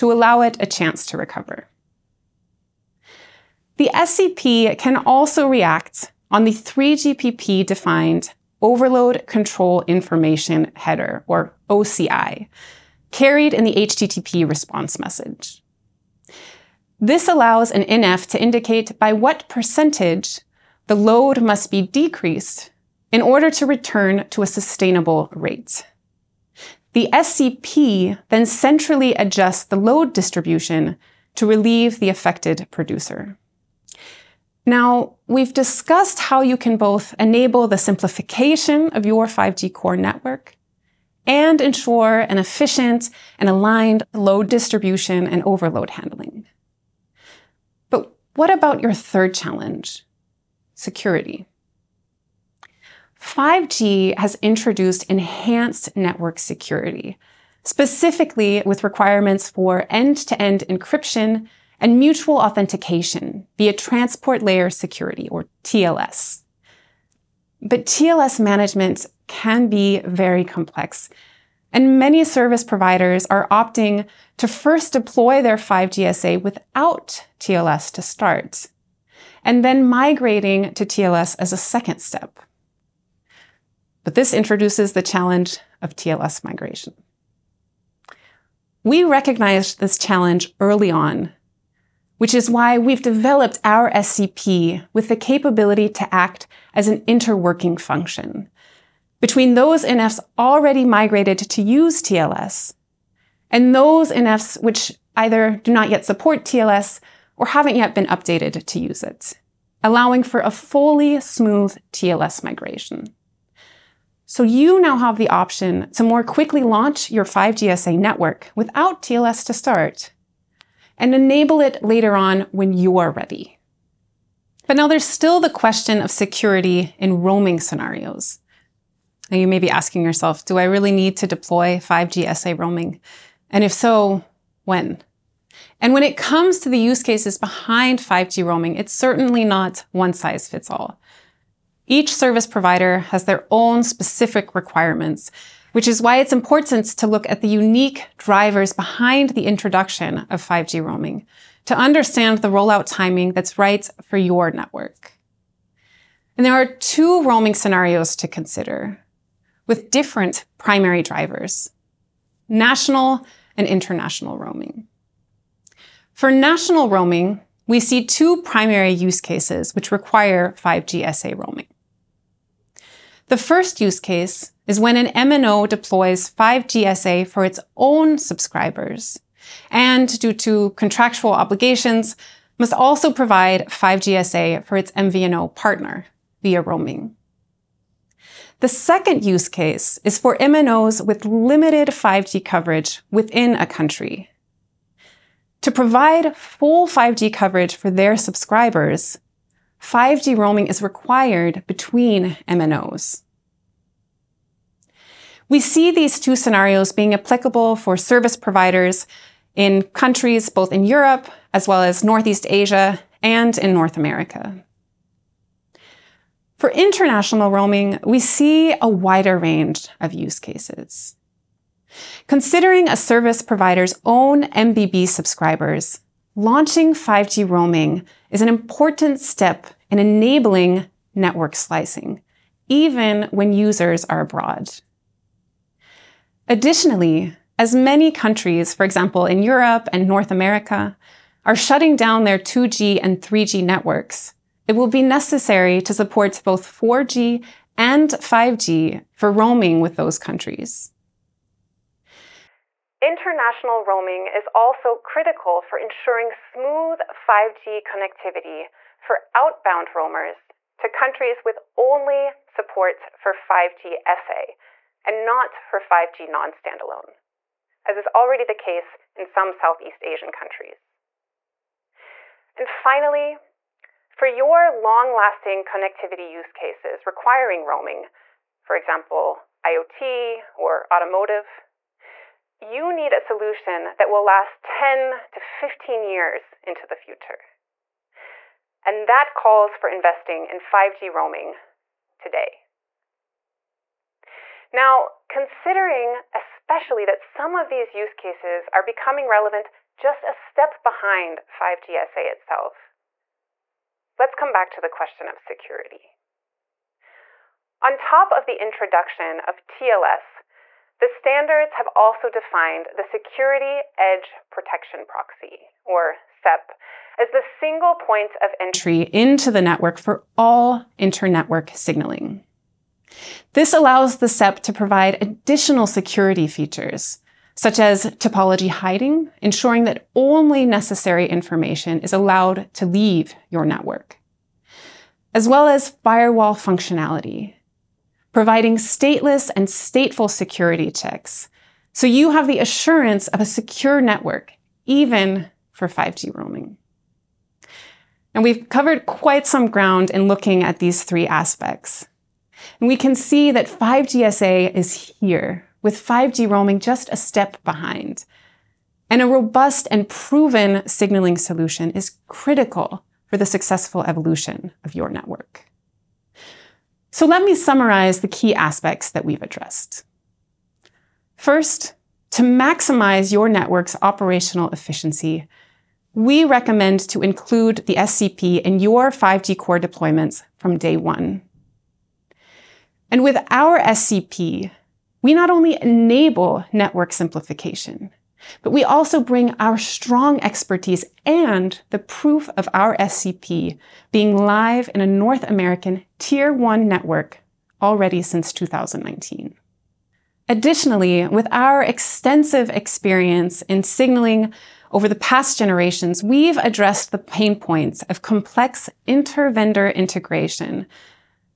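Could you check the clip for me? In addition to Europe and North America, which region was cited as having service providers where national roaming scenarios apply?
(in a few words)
Northeast Asia.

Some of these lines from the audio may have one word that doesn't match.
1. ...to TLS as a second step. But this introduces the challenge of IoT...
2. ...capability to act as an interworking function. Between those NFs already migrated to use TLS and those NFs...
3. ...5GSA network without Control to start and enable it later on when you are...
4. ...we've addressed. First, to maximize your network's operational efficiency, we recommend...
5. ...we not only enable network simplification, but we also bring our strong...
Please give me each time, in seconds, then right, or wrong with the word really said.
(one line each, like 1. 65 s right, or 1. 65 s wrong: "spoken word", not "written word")
1. 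80 s wrong: "TLS", not "IoT"
2. 95 s right
3. 117 s wrong: "TLS", not "Control"
4. 369 s right
5. 385 s right.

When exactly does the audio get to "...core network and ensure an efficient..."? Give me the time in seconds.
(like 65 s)
39 s.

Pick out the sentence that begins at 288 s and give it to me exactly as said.
And that calls for investing in 5G roaming today.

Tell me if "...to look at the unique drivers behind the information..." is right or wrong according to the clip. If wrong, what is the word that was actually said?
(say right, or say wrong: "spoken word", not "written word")
wrong: "introduction", not "information".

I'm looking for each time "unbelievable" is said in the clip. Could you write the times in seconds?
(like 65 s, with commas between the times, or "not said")
not said.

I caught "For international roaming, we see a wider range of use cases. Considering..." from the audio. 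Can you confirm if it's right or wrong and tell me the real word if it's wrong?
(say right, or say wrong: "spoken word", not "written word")
right.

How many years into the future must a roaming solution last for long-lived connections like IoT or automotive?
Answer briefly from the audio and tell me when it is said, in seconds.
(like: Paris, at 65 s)
10 to 15 years, at 284 s.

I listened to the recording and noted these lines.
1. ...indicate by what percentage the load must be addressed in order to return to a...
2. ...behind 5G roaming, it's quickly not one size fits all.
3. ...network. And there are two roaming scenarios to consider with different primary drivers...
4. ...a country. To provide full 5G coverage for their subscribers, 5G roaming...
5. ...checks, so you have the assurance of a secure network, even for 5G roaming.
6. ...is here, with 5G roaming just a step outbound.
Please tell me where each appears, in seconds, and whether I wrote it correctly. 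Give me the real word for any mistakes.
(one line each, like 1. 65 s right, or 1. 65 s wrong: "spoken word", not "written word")
1. 18 s wrong: "decreased", not "addressed"
2. 137 s wrong: "certainly", not "quickly"
3. 154 s right
4. 193 s right
5. 340 s right
6. 354 s wrong: "behind", not "outbound".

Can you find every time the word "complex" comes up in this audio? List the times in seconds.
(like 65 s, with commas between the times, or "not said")
70 s, 408 s.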